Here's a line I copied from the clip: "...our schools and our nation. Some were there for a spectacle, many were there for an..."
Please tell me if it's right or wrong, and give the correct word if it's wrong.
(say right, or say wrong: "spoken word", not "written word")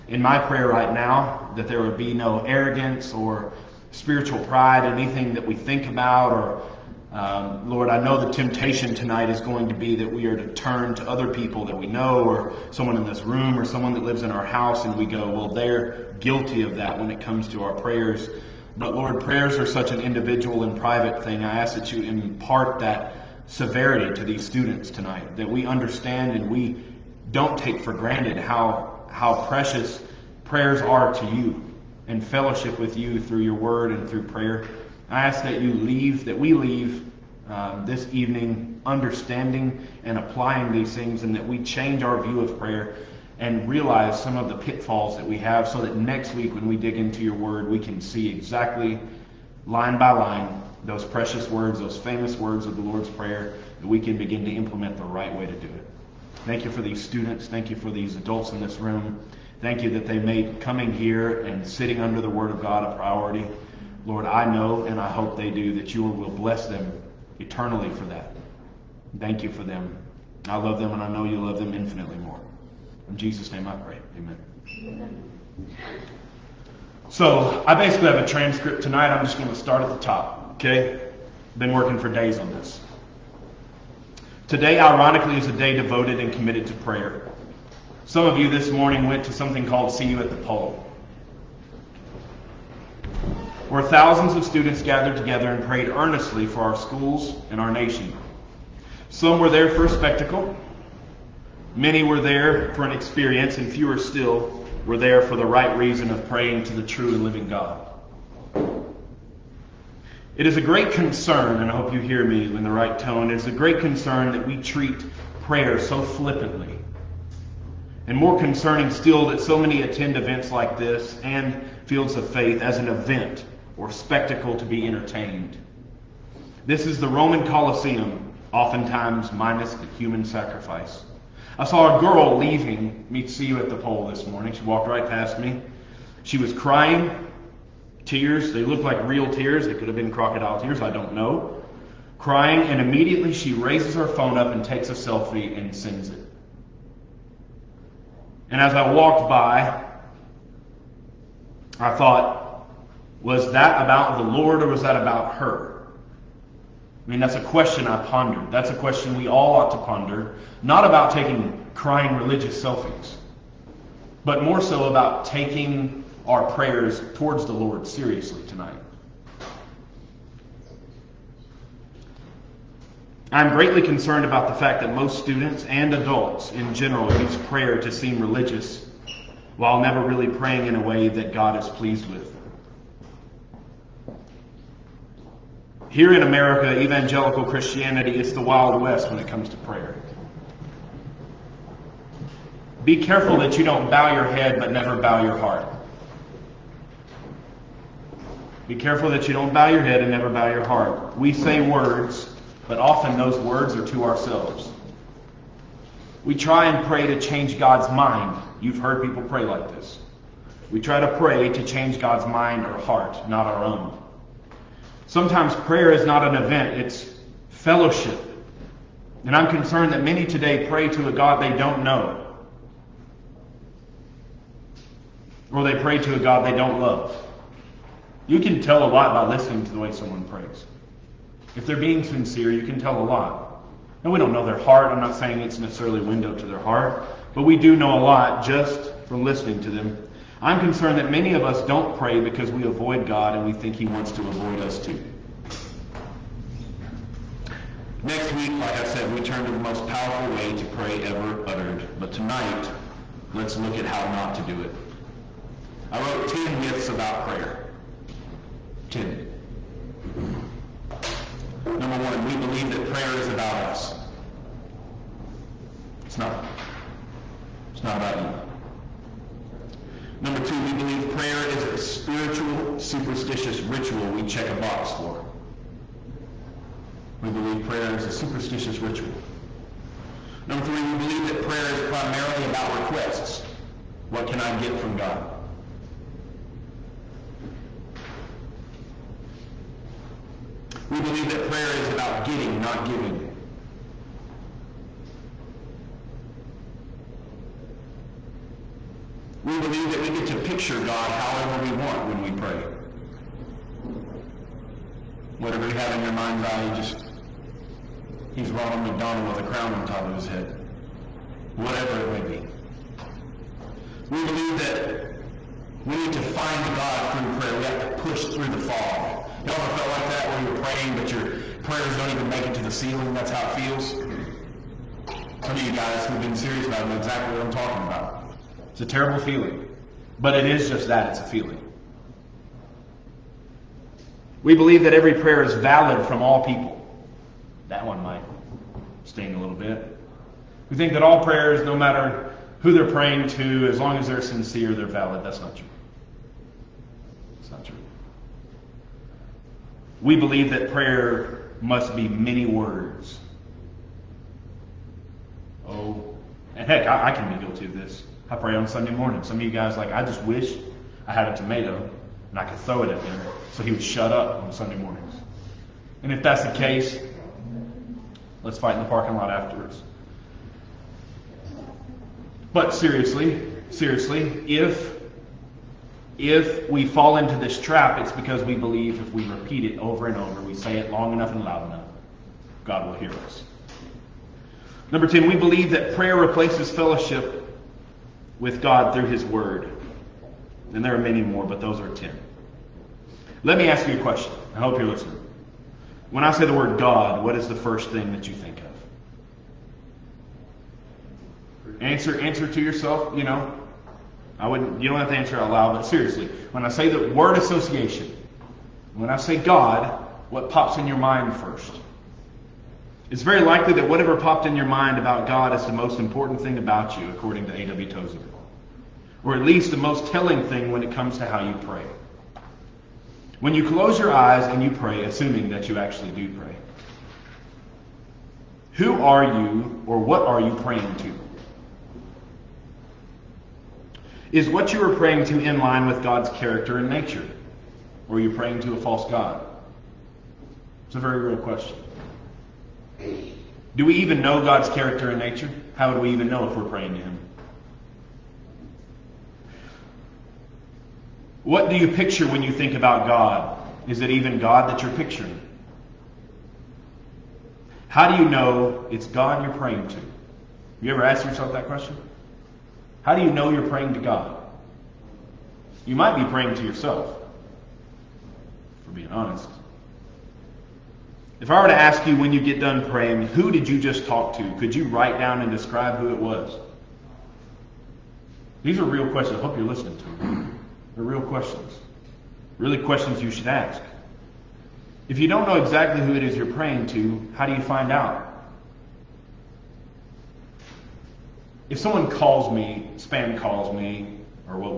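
right.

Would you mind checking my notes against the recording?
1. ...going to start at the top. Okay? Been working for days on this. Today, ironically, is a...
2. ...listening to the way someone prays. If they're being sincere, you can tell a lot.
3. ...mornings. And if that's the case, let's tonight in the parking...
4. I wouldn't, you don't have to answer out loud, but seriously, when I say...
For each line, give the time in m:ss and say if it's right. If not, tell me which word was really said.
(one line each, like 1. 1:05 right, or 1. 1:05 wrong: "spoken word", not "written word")
1. 1:19 right
2. 3:49 right
3. 6:04 wrong: "fight", not "tonight"
4. 6:44 right.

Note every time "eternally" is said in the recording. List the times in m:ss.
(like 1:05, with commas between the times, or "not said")
1:07.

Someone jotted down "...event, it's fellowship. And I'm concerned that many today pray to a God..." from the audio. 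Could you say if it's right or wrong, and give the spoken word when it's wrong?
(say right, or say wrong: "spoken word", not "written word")
right.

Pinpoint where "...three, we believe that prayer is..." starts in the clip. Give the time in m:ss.
4:40.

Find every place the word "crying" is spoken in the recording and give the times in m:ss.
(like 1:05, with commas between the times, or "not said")
2:16, 2:22, 2:41.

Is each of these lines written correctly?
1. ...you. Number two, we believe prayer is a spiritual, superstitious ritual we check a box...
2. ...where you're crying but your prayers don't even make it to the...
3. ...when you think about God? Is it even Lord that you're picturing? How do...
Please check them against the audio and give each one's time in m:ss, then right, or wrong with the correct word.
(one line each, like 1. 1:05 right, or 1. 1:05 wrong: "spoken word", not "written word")
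1. 4:28 right
2. 5:20 wrong: "praying", not "crying"
3. 7:32 wrong: "God", not "Lord".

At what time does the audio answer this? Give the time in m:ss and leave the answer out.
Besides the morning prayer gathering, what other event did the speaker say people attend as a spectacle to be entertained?
2:01.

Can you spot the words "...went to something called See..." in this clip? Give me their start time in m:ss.
1:29.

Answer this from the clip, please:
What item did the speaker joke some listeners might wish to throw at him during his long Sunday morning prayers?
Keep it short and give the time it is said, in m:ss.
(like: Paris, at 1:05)
a tomato, at 6:01.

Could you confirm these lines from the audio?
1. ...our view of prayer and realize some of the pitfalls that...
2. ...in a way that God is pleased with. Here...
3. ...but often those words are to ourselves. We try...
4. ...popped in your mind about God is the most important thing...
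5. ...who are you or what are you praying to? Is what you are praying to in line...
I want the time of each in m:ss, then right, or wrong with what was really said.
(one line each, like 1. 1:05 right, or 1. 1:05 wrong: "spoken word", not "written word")
1. 0:42 right
2. 3:00 right
3. 3:22 right
4. 6:54 right
5. 7:08 right.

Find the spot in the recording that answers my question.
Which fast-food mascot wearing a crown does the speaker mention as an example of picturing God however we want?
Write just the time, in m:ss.
5:08.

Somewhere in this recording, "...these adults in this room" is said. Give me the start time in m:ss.
0:57.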